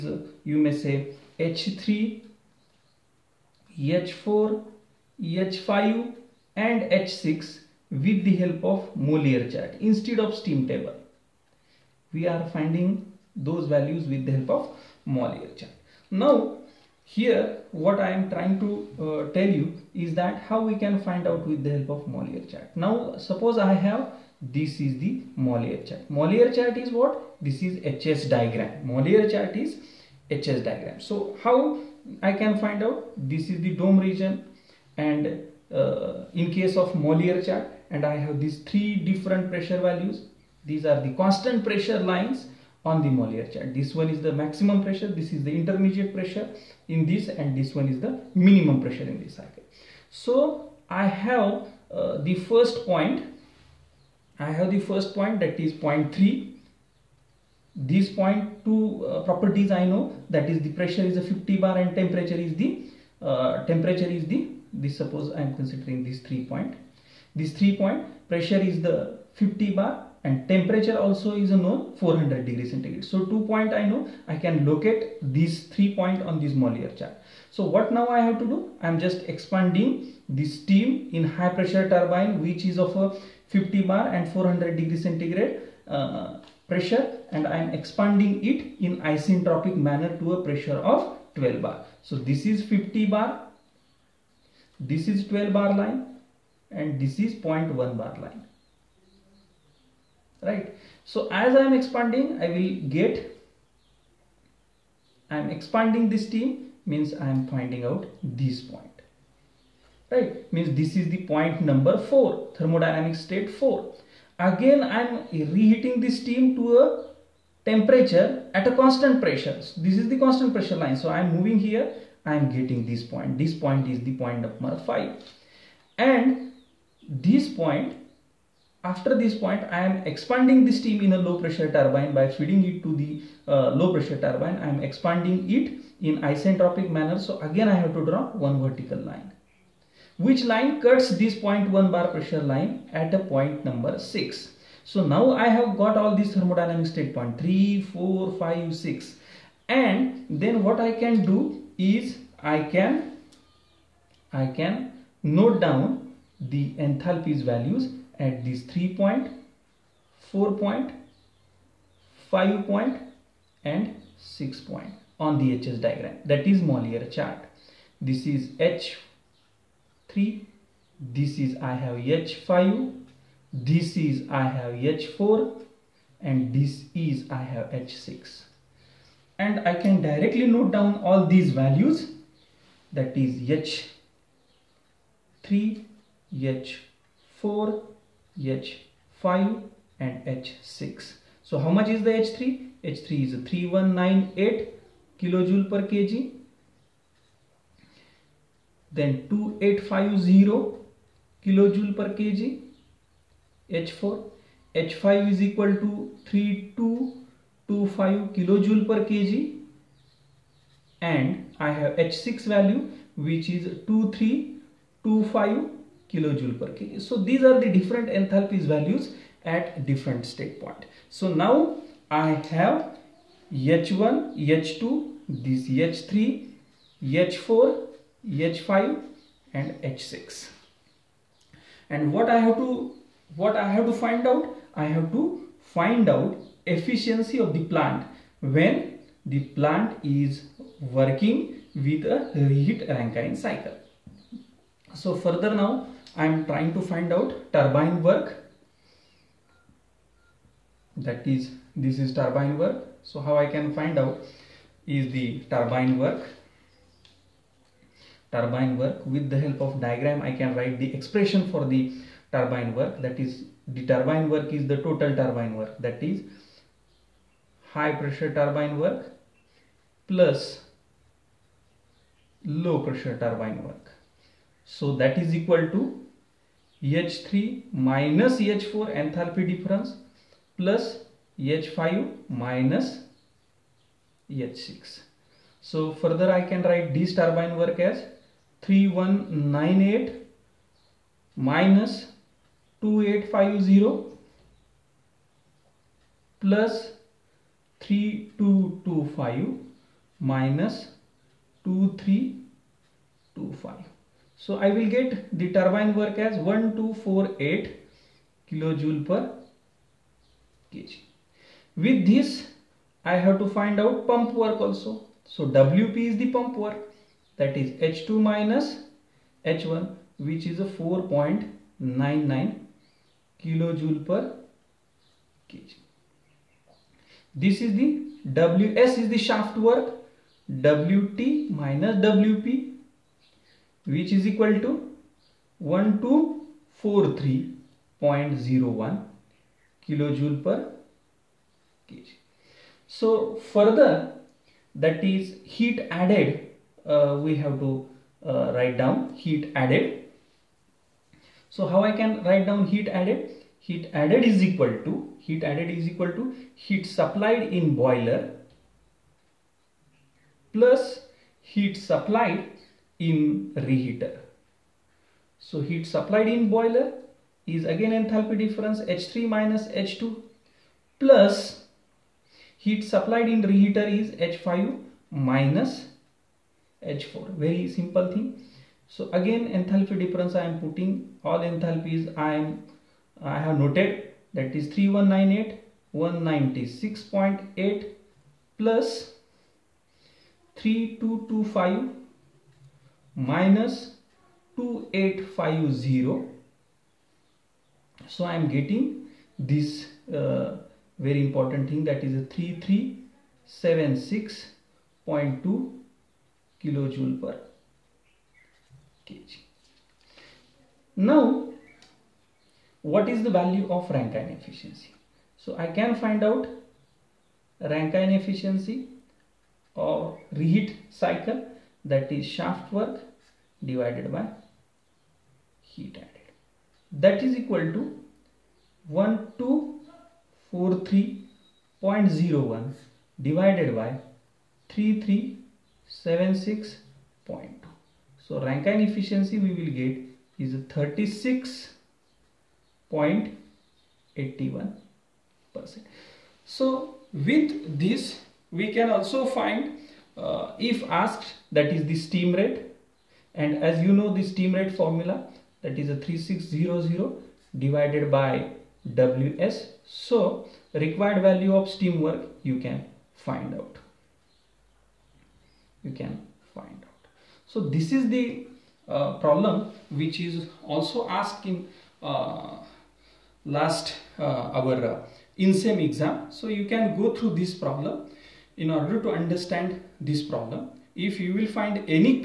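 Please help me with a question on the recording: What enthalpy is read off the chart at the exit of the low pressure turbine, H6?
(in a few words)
2325 kJ/kg.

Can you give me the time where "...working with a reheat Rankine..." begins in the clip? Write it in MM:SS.
04:00.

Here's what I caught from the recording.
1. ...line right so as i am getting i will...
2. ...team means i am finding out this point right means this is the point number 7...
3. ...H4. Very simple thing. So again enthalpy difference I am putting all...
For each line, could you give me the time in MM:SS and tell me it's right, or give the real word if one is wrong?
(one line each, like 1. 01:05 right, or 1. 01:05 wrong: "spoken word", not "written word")
1. 01:38 wrong: "expanding", not "getting"
2. 01:46 wrong: "4", not "7"
3. 06:16 right.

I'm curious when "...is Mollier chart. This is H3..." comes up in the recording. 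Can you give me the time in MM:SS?
02:46.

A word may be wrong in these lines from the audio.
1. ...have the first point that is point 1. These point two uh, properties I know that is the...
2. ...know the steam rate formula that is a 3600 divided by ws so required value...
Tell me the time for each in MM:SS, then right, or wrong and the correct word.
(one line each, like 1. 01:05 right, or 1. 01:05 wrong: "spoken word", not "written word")
1. 00:54 wrong: "3", not "1"
2. 07:33 right.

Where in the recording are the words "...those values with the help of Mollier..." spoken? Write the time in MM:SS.
00:13.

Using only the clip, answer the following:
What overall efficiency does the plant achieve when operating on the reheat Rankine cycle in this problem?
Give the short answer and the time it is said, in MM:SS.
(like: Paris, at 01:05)
36.81%, at 07:20.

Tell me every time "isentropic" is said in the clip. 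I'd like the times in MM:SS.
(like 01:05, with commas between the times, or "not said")
01:29, 02:16.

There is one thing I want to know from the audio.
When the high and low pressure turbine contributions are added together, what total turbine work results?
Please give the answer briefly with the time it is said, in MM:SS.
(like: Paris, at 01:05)
1248 kJ/kg, at 05:06.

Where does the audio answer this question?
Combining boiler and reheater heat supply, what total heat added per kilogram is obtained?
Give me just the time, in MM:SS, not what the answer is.
06:43.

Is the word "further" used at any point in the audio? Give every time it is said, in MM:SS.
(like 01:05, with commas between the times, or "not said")
04:05, 04:45, 05:43.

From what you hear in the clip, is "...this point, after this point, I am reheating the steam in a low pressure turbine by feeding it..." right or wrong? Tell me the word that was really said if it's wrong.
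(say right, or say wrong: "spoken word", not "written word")
wrong: "expanding", not "reheating".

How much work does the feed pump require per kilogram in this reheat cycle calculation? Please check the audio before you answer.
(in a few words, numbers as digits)
4.99 kJ/kg.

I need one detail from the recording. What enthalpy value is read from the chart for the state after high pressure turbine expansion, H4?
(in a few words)
2850 kJ/kg.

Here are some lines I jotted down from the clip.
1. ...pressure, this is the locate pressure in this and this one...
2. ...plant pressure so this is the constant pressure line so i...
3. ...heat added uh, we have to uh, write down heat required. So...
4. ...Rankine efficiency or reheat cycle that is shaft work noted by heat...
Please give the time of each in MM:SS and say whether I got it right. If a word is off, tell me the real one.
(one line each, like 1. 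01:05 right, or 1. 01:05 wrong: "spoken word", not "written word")
1. 00:44 wrong: "intermediate", not "locate"
2. 01:58 wrong: "constant", not "plant"
3. 05:45 wrong: "added", not "required"
4. 06:57 wrong: "divided", not "noted".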